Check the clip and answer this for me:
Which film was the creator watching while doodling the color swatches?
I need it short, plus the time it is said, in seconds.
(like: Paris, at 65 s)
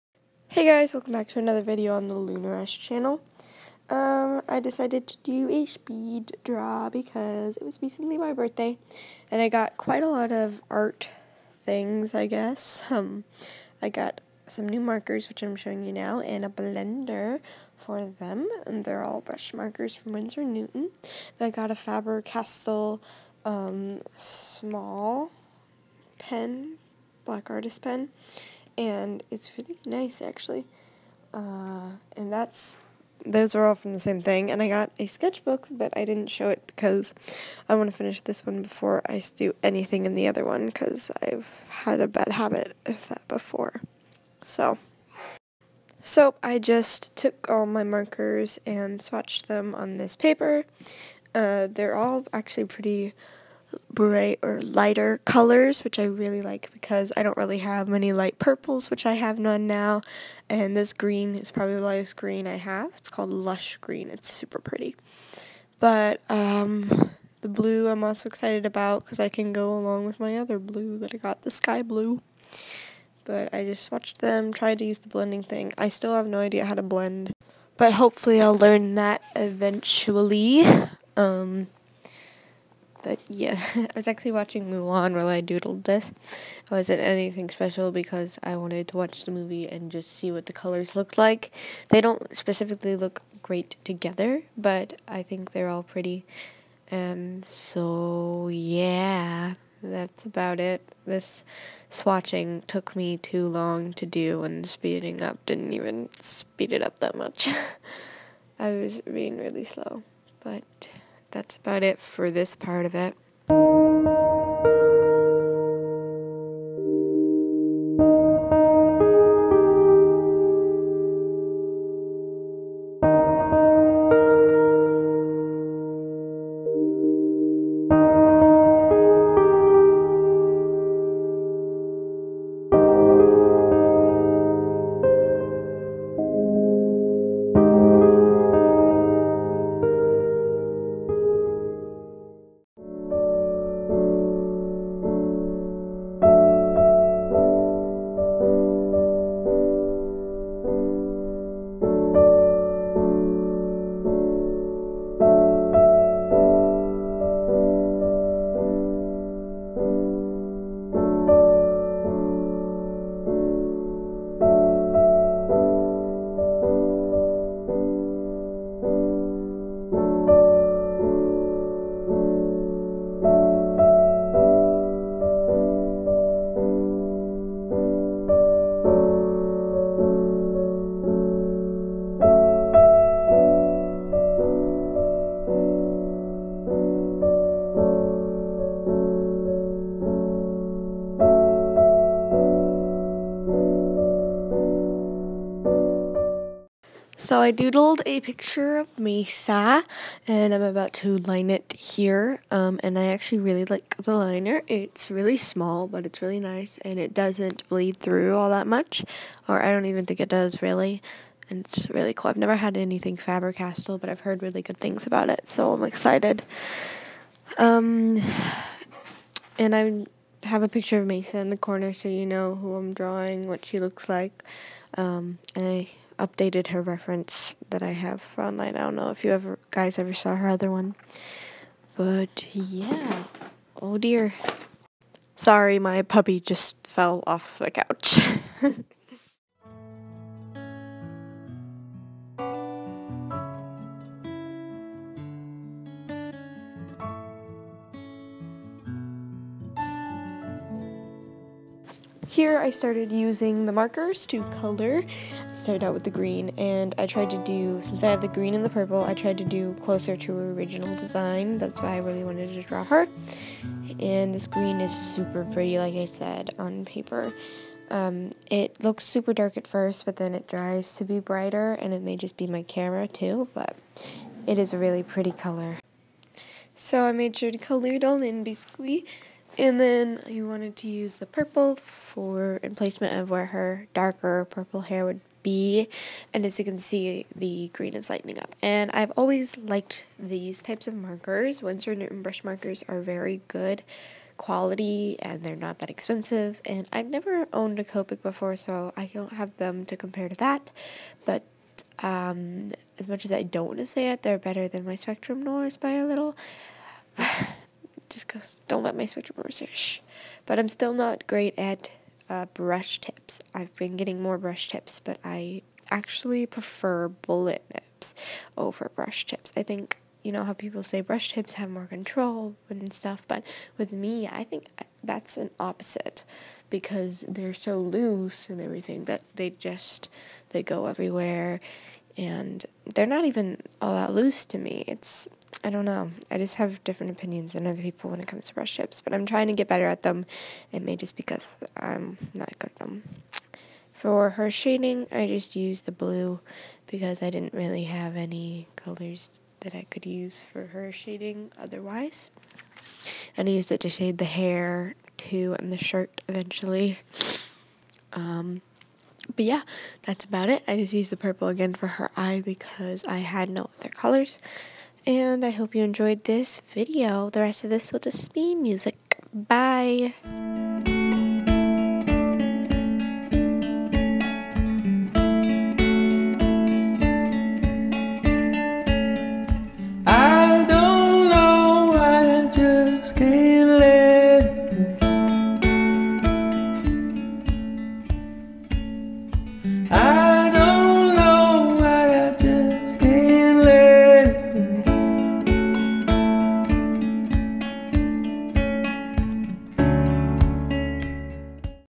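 Mulan, at 84 s.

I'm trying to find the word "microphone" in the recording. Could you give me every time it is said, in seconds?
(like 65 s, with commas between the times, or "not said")
not said.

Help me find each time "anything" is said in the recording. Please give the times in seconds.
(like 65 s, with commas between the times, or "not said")
39 s, 87 s, 212 s.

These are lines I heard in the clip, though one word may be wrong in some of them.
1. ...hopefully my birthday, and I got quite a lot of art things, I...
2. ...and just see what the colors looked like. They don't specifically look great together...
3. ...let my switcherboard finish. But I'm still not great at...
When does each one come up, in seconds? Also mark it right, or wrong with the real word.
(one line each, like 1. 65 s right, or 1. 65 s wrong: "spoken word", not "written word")
1. 7 s wrong: "recently", not "hopefully"
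2. 89 s right
3. 308 s wrong: "swish", not "finish".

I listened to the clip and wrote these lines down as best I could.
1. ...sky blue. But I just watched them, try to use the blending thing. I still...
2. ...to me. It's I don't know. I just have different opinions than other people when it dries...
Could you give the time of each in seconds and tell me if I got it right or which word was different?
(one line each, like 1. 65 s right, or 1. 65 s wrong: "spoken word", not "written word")
1. 71 s right
2. 334 s wrong: "comes", not "dries".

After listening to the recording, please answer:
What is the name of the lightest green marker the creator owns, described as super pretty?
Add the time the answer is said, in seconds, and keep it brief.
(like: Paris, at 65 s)
Lush Green, at 63 s.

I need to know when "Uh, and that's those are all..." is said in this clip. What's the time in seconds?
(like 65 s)
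31 s.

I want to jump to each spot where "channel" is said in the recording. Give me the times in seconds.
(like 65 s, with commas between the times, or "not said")
2 s.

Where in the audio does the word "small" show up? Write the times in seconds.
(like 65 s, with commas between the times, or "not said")
24 s, 205 s.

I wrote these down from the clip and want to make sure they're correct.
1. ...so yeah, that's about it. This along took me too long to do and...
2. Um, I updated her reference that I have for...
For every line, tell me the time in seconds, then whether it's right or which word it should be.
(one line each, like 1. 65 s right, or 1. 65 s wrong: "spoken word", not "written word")
1. 97 s wrong: "swatching", not "along"
2. 224 s right.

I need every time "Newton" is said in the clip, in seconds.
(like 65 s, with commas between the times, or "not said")
20 s, 291 s.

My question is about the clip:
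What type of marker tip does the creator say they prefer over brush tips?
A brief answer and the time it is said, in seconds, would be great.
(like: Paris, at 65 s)
bullet nibs, at 317 s.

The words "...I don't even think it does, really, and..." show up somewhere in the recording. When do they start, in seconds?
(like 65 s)
209 s.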